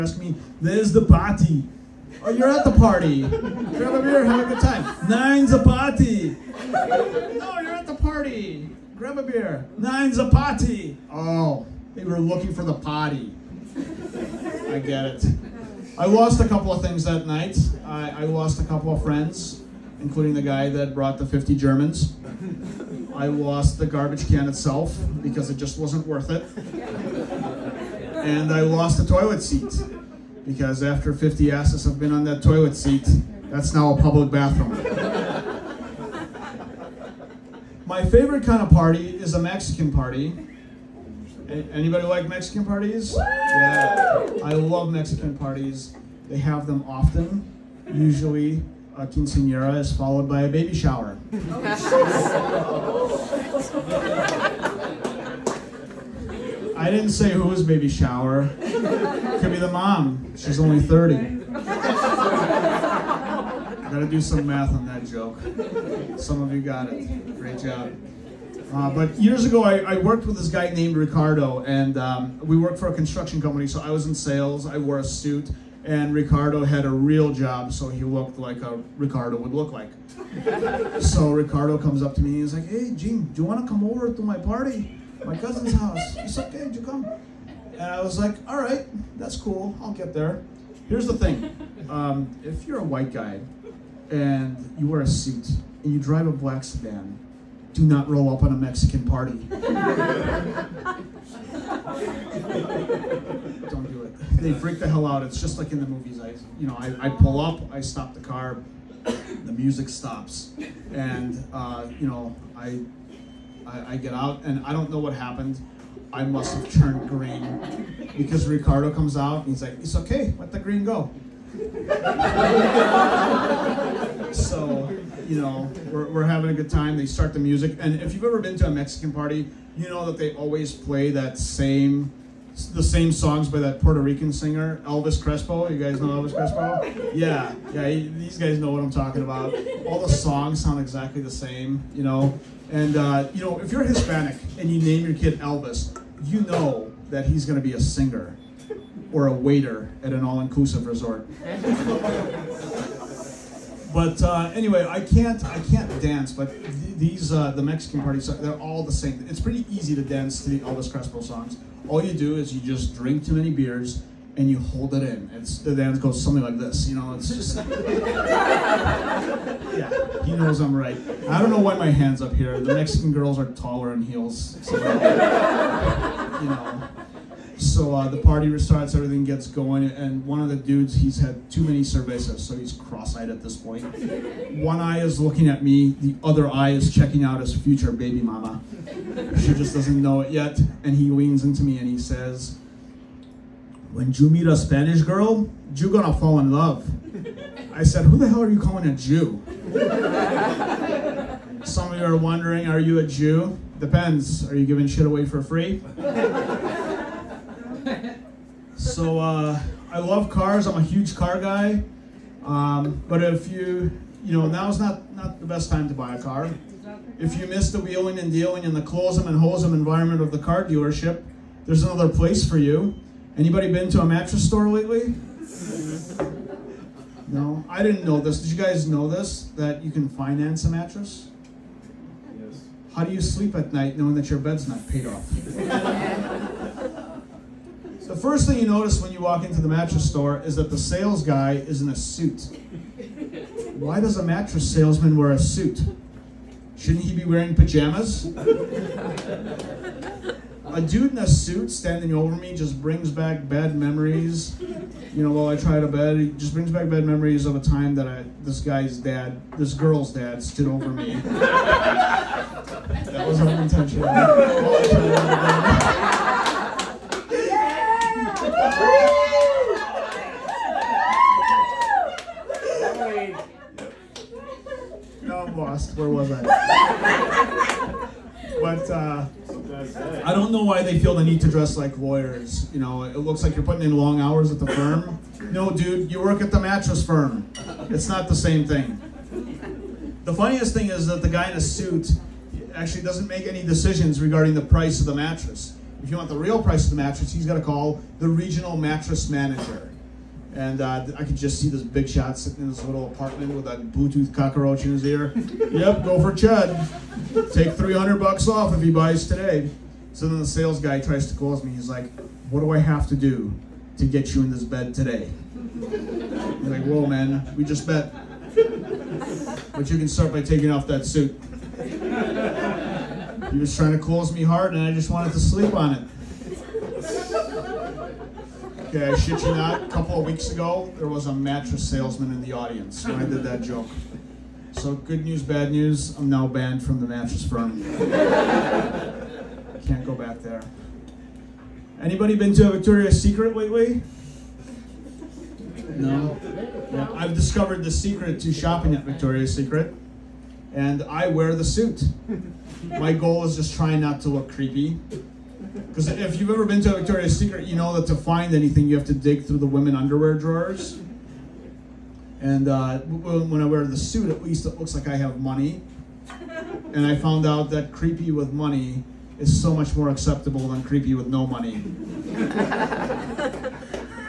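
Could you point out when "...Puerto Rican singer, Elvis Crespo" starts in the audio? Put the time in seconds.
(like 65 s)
133 s.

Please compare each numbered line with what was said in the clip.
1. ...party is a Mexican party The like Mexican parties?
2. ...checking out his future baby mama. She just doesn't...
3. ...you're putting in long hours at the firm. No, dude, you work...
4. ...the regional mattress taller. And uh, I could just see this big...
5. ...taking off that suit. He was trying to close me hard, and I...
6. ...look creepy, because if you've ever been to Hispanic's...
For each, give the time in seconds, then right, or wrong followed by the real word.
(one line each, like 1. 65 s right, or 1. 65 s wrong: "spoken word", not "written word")
1. 38 s wrong: "Anybody", not "The"
2. 186 s right
3. 283 s right
4. 298 s wrong: "manager", not "taller"
5. 320 s right
6. 354 s wrong: "Victoria", not "Hispanic".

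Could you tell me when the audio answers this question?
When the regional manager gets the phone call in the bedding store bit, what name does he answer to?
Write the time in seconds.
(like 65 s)
306 s.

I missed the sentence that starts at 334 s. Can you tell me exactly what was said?
So good news, bad news, I'm now banned from the mattress firm.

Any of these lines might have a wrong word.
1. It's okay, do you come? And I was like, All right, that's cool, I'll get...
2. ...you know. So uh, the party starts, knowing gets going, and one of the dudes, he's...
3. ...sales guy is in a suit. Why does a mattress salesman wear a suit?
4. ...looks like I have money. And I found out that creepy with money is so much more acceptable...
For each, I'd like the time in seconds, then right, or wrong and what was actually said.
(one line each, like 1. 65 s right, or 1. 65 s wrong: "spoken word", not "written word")
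1. 86 s right
2. 176 s wrong: "everything", not "knowing"
3. 240 s right
4. 364 s right.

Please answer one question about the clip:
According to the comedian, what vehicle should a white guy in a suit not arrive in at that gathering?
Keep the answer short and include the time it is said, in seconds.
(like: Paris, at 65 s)
black sedan, at 96 s.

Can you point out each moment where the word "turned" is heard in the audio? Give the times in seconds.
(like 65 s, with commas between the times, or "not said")
116 s.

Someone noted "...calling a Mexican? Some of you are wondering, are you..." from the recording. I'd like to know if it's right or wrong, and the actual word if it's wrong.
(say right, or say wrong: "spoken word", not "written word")
wrong: "Jew", not "Mexican".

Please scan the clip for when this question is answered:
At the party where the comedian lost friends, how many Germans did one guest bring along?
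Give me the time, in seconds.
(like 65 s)
21 s.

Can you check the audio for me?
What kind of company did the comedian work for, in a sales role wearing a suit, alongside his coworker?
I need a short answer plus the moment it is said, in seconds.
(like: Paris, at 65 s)
construction company, at 72 s.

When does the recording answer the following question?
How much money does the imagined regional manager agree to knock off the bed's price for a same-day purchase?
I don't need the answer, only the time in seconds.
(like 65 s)
307 s.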